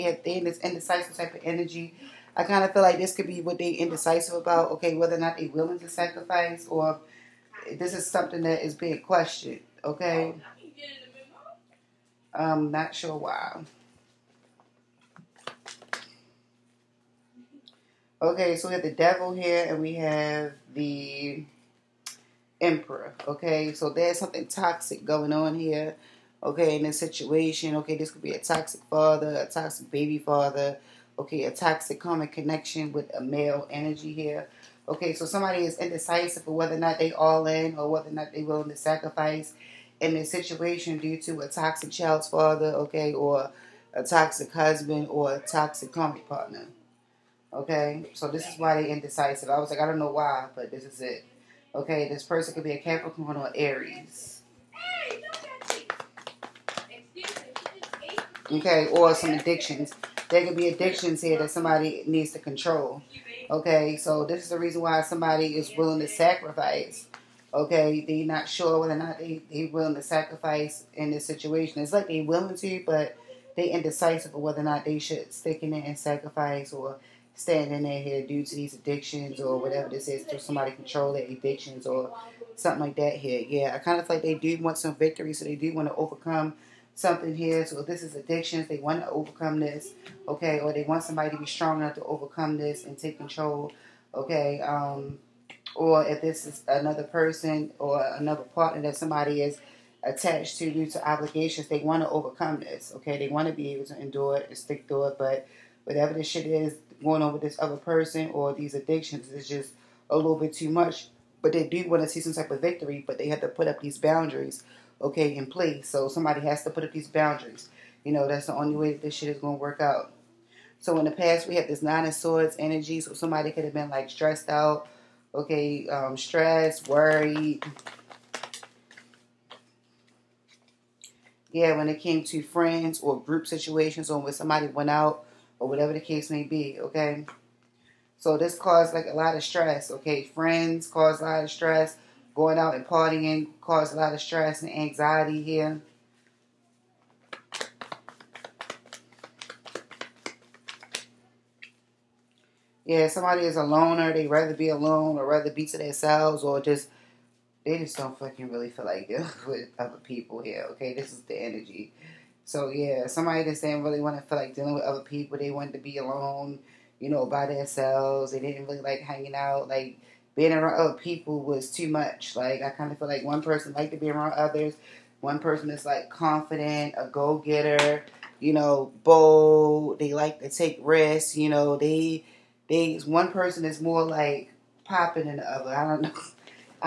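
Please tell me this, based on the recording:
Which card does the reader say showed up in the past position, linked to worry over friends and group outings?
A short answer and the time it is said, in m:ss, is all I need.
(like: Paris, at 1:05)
Nine of Swords, at 2:01.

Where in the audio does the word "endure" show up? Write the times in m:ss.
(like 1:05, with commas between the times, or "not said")
1:43.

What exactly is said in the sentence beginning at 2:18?
So this caused like a lot of stress, okay?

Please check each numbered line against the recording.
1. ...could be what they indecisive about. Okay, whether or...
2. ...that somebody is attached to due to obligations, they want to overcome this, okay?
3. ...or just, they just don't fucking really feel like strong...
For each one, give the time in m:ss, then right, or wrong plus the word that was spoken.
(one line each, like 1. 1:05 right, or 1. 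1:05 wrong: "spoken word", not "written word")
1. 0:03 right
2. 1:38 right
3. 2:36 wrong: "dealing", not "strong".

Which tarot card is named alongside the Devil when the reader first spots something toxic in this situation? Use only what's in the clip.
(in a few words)
The Emperor.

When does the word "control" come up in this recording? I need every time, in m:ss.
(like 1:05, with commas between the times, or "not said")
1:02, 1:20, 1:33.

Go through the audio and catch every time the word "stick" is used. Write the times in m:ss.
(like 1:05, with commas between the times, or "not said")
1:15, 1:44.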